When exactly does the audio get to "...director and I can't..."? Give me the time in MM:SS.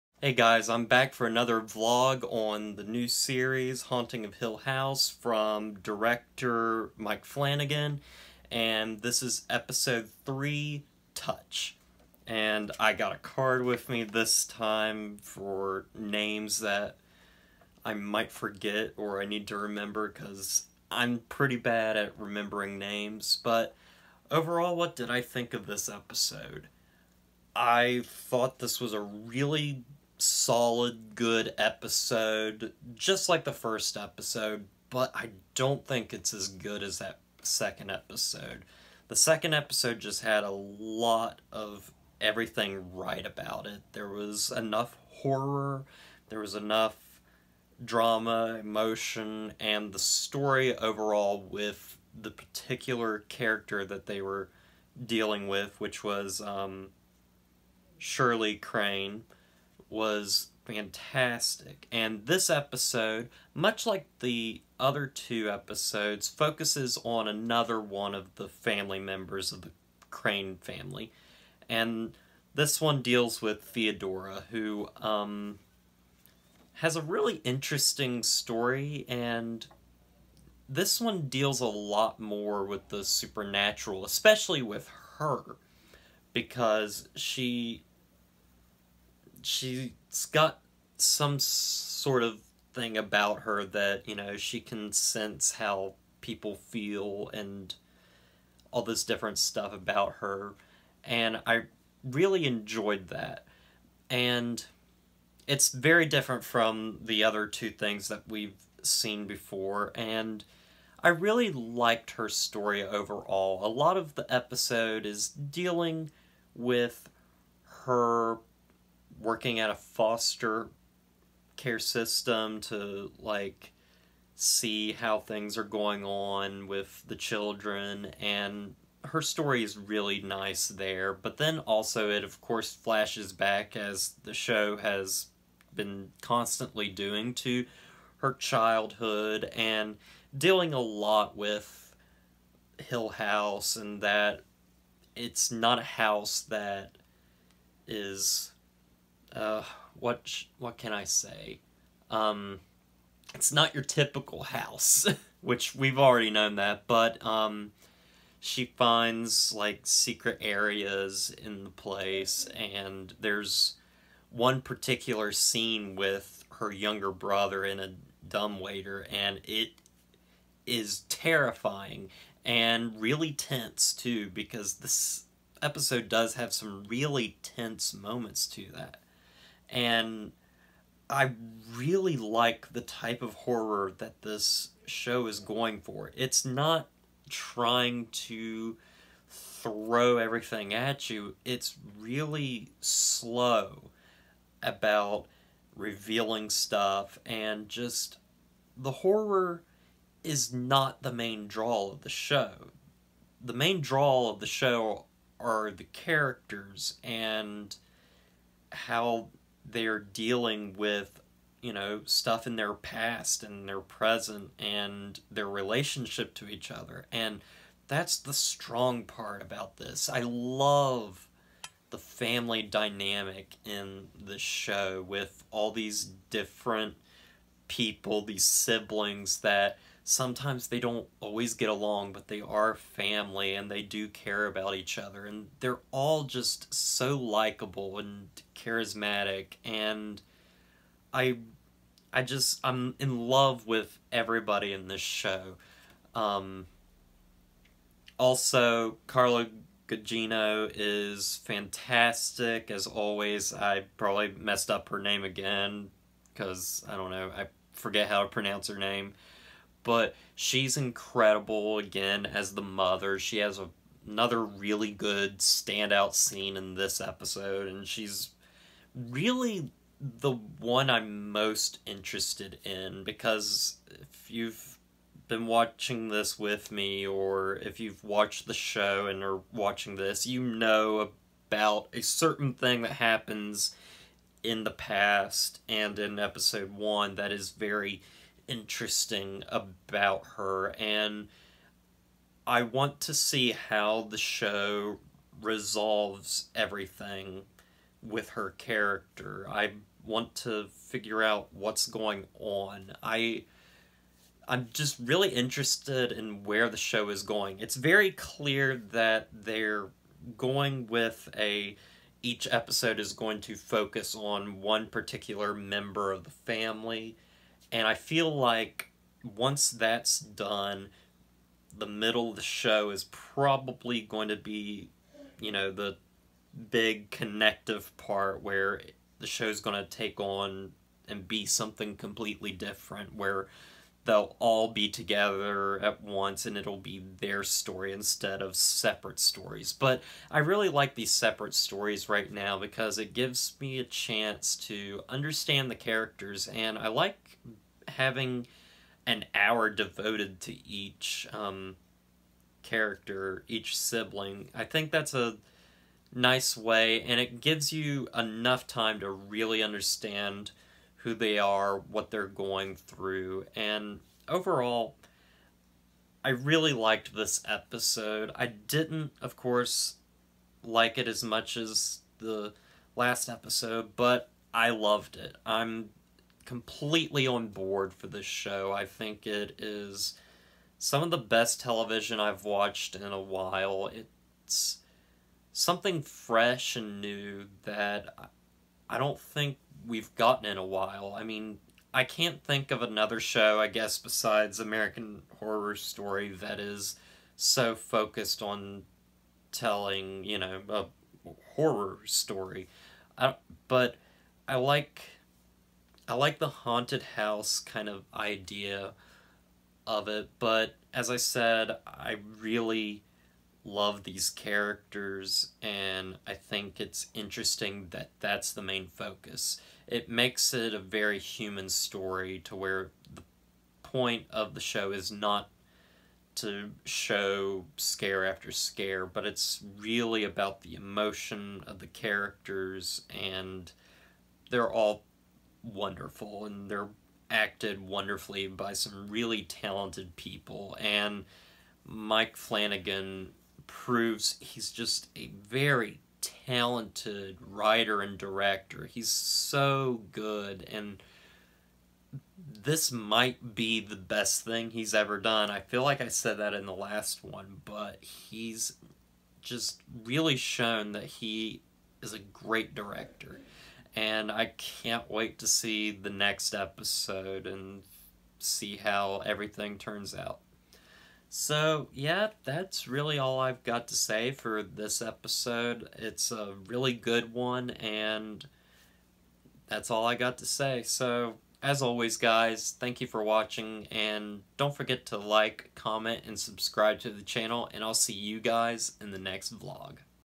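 07:42.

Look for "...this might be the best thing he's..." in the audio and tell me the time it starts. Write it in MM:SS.
07:32.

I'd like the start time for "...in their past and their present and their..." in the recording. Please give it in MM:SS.
03:32.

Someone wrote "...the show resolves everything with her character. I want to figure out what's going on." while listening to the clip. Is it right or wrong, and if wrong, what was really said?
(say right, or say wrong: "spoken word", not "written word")
right.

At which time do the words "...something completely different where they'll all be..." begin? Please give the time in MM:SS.
05:31.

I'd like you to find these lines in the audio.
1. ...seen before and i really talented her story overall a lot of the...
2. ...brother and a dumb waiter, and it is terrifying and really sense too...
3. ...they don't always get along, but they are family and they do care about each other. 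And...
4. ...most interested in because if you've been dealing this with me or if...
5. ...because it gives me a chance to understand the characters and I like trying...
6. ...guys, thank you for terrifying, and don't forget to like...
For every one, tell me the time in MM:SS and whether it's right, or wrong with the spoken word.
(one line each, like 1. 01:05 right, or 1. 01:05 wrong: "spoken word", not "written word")
1. 01:48 wrong: "liked", not "talented"
2. 02:47 wrong: "tense", not "sense"
3. 03:50 right
4. 04:31 wrong: "watching", not "dealing"
5. 05:42 wrong: "having", not "trying"
6. 08:02 wrong: "watching", not "terrifying".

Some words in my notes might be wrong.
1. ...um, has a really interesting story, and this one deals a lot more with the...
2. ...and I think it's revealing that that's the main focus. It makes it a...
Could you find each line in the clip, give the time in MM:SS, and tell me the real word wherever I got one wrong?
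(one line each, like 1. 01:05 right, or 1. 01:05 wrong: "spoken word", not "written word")
1. 01:15 right
2. 06:55 wrong: "interesting", not "revealing".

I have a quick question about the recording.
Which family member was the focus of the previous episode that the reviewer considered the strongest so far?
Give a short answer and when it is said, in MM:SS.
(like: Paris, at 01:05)
Shirley Crain, at 00:57.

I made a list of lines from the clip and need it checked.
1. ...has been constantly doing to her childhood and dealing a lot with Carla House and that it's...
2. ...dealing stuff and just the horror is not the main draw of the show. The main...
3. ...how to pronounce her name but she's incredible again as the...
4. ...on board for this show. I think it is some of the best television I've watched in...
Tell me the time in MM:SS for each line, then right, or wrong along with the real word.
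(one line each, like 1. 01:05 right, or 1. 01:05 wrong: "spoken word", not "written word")
1. 02:14 wrong: "Hill", not "Carla"
2. 03:15 wrong: "revealing", not "dealing"
3. 04:18 right
4. 06:17 right.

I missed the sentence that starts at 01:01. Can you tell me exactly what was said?
And this episode, much like the other two episodes, focuses on another one of the family members of the Crain family.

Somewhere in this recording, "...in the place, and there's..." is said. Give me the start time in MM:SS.
02:41.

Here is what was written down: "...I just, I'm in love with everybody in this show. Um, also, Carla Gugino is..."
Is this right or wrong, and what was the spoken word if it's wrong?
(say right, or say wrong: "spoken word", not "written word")
right.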